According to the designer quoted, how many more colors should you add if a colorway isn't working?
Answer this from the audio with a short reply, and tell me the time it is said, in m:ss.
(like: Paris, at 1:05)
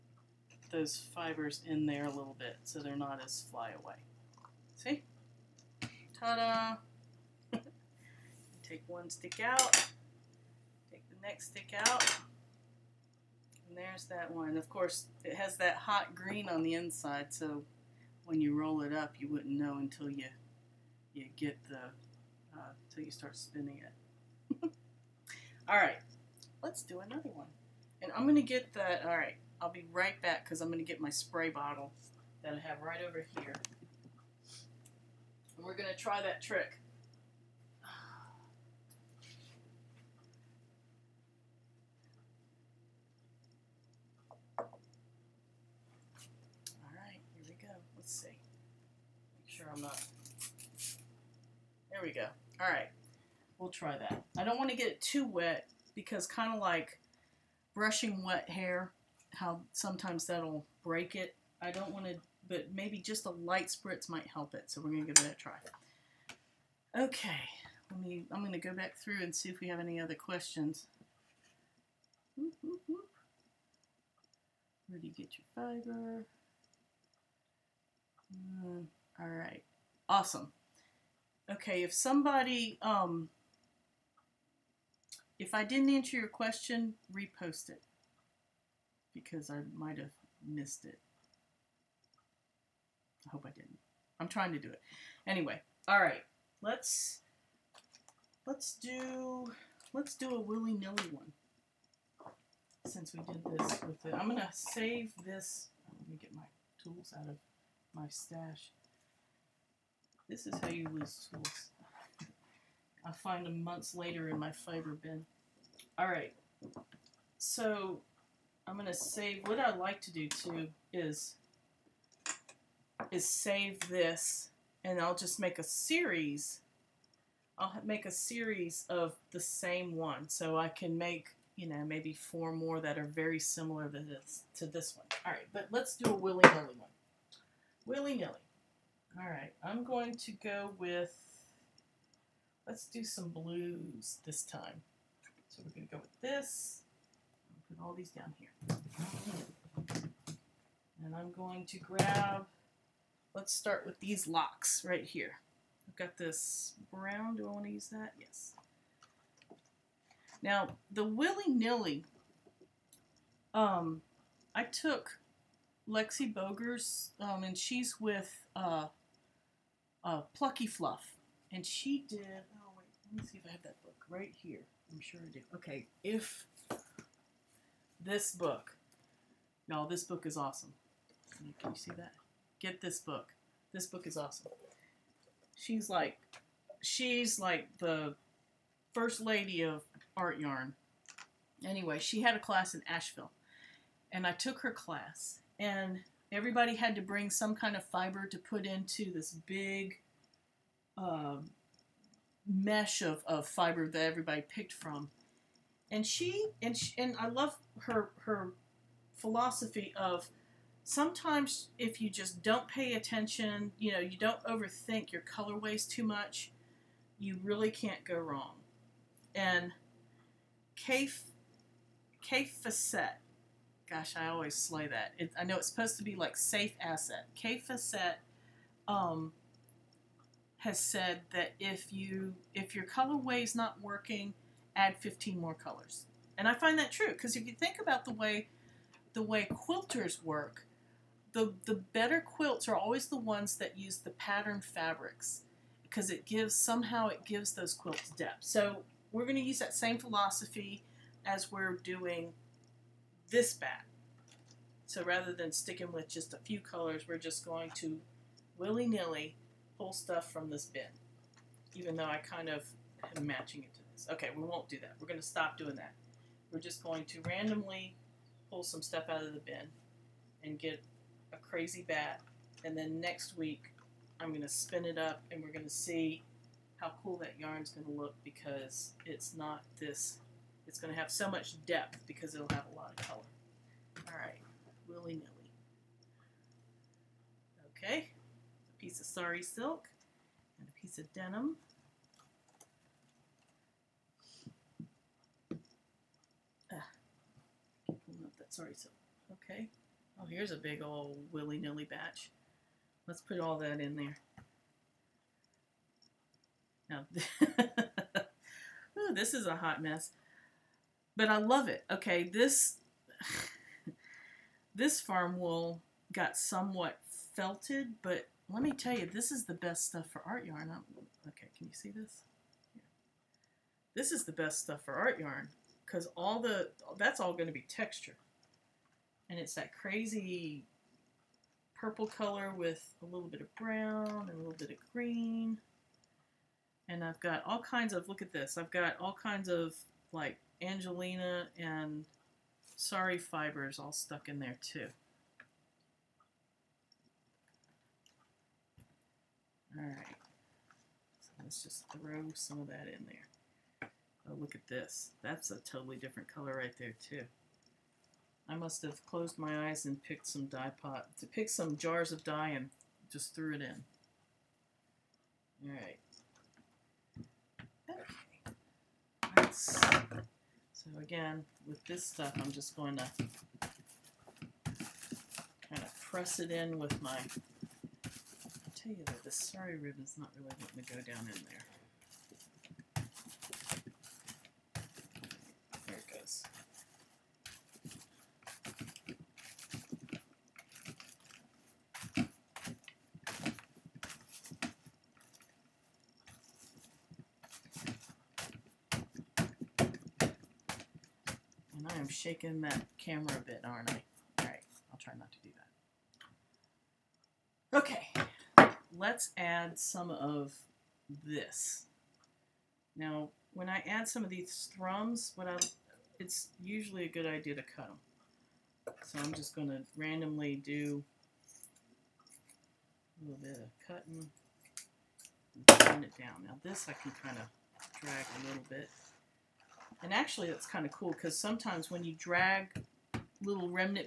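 15, at 3:54.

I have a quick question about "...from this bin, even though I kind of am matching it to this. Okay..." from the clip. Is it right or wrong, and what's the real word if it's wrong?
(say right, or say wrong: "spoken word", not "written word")
right.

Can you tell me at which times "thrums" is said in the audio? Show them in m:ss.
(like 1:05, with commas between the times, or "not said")
6:54.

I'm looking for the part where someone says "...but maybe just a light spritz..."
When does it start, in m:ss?
1:02.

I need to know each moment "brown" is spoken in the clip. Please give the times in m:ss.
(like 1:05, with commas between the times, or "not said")
2:36, 5:33.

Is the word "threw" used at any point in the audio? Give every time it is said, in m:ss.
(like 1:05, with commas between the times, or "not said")
6:03.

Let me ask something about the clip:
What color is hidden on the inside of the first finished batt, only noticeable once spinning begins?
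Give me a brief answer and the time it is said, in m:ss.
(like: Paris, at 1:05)
hot green, at 0:15.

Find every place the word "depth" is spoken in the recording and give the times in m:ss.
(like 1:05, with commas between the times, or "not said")
4:08, 4:41.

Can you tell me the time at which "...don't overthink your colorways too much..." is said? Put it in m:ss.
3:34.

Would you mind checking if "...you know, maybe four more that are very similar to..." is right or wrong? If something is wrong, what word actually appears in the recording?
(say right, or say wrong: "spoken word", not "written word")
right.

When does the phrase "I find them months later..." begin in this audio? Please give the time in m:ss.
1:53.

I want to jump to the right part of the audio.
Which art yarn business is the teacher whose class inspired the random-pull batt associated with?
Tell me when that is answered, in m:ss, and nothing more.
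2:50.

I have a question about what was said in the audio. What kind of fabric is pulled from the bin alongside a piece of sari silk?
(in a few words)
denim.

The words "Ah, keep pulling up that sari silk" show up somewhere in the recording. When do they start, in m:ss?
4:56.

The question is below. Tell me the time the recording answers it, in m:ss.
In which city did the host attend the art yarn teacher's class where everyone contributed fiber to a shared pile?
3:12.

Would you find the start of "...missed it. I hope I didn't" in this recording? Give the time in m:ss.
1:30.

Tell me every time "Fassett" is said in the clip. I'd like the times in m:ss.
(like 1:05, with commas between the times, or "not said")
3:42, 3:47.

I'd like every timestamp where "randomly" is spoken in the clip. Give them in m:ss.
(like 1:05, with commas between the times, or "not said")
4:27, 6:59.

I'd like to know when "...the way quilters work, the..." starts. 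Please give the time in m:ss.
3:59.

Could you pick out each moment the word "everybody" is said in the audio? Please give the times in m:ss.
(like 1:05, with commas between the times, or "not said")
3:16, 3:24.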